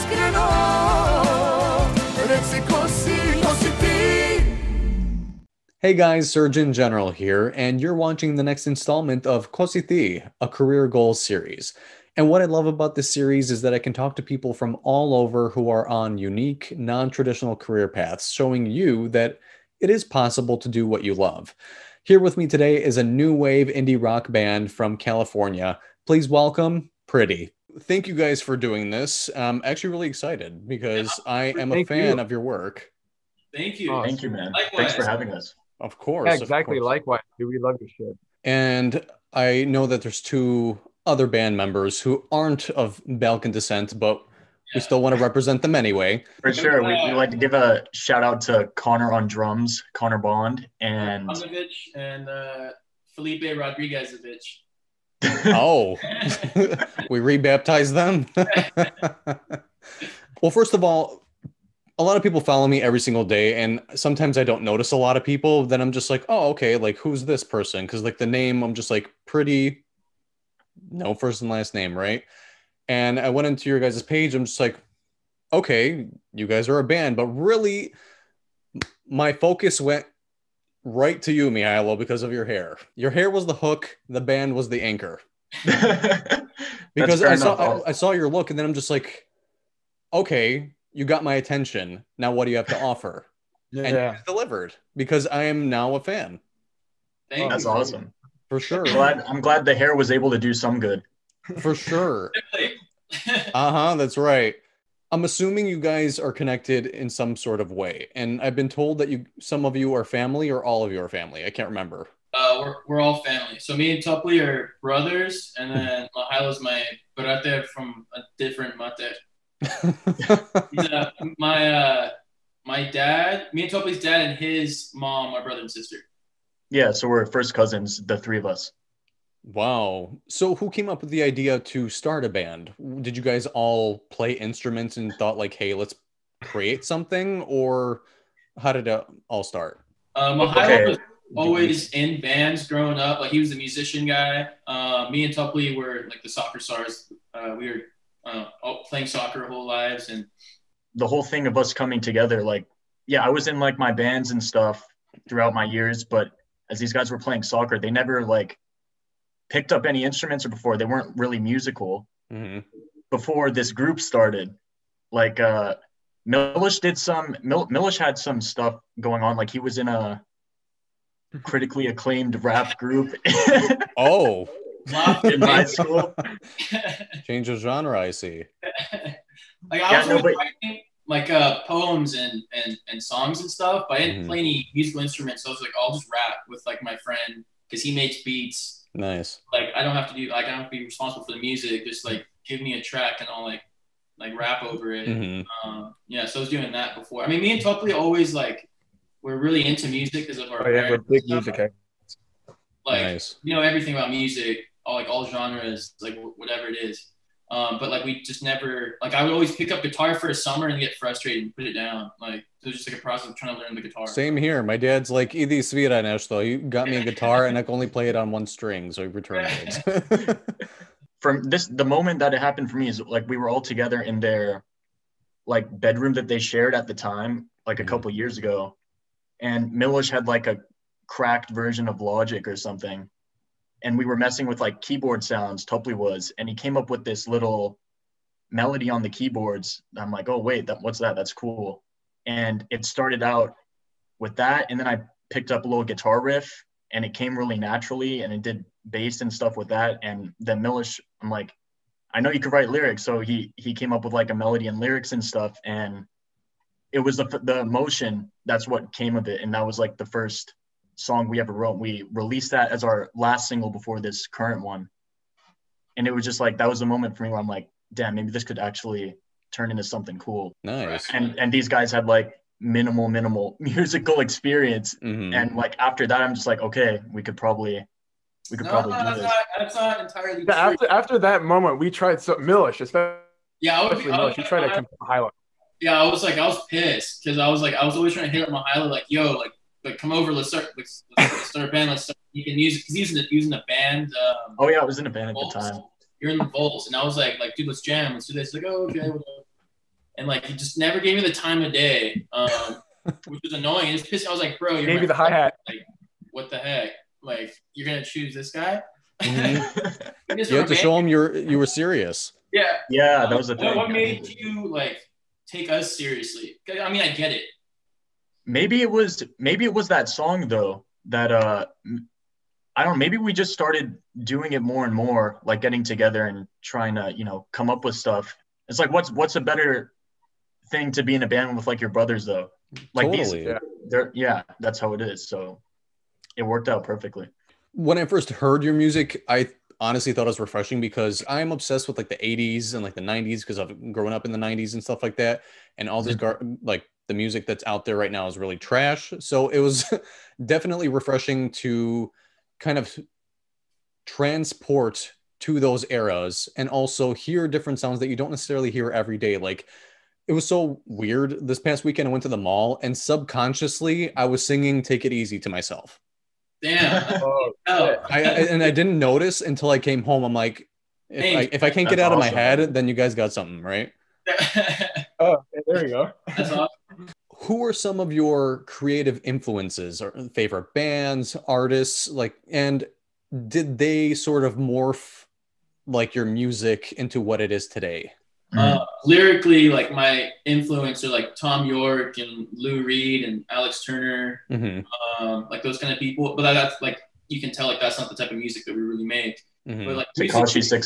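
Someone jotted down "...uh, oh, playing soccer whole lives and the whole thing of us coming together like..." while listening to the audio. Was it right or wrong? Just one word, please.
right.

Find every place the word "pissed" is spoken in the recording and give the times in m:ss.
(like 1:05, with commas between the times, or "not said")
4:46, 5:04.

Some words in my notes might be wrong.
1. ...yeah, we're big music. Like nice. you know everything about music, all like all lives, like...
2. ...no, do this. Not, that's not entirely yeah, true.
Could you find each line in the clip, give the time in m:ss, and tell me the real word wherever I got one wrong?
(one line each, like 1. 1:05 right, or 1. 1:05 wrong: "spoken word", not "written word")
1. 3:20 wrong: "genres", not "lives"
2. 4:38 right.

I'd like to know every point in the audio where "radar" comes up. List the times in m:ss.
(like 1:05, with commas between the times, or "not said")
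not said.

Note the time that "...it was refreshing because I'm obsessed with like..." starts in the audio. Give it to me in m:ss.
5:40.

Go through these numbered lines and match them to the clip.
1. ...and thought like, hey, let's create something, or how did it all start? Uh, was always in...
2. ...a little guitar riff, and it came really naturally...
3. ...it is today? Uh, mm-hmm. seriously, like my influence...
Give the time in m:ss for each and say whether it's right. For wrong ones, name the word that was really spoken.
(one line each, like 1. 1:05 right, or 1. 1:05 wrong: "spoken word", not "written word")
1. 2:14 right
2. 4:05 right
3. 6:27 wrong: "lyrically", not "seriously".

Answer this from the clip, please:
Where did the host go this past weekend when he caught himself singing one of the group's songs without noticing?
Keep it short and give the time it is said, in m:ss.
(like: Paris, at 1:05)
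the mall, at 6:02.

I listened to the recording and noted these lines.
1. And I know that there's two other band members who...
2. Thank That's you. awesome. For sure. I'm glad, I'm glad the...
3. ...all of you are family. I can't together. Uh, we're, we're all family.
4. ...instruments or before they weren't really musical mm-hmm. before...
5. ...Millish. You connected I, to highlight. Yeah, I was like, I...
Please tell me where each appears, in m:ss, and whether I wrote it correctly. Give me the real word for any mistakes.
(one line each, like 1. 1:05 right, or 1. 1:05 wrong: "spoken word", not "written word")
1. 0:38 right
2. 1:37 right
3. 1:50 wrong: "remember", not "together"
4. 2:40 right
5. 4:44 wrong: "tried", not "connected".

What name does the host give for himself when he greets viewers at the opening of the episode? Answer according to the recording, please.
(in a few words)
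Srdjan General.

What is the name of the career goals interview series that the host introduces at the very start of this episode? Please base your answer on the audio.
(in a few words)
Ko Si Ti.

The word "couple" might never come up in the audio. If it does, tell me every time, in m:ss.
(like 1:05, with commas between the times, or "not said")
3:47.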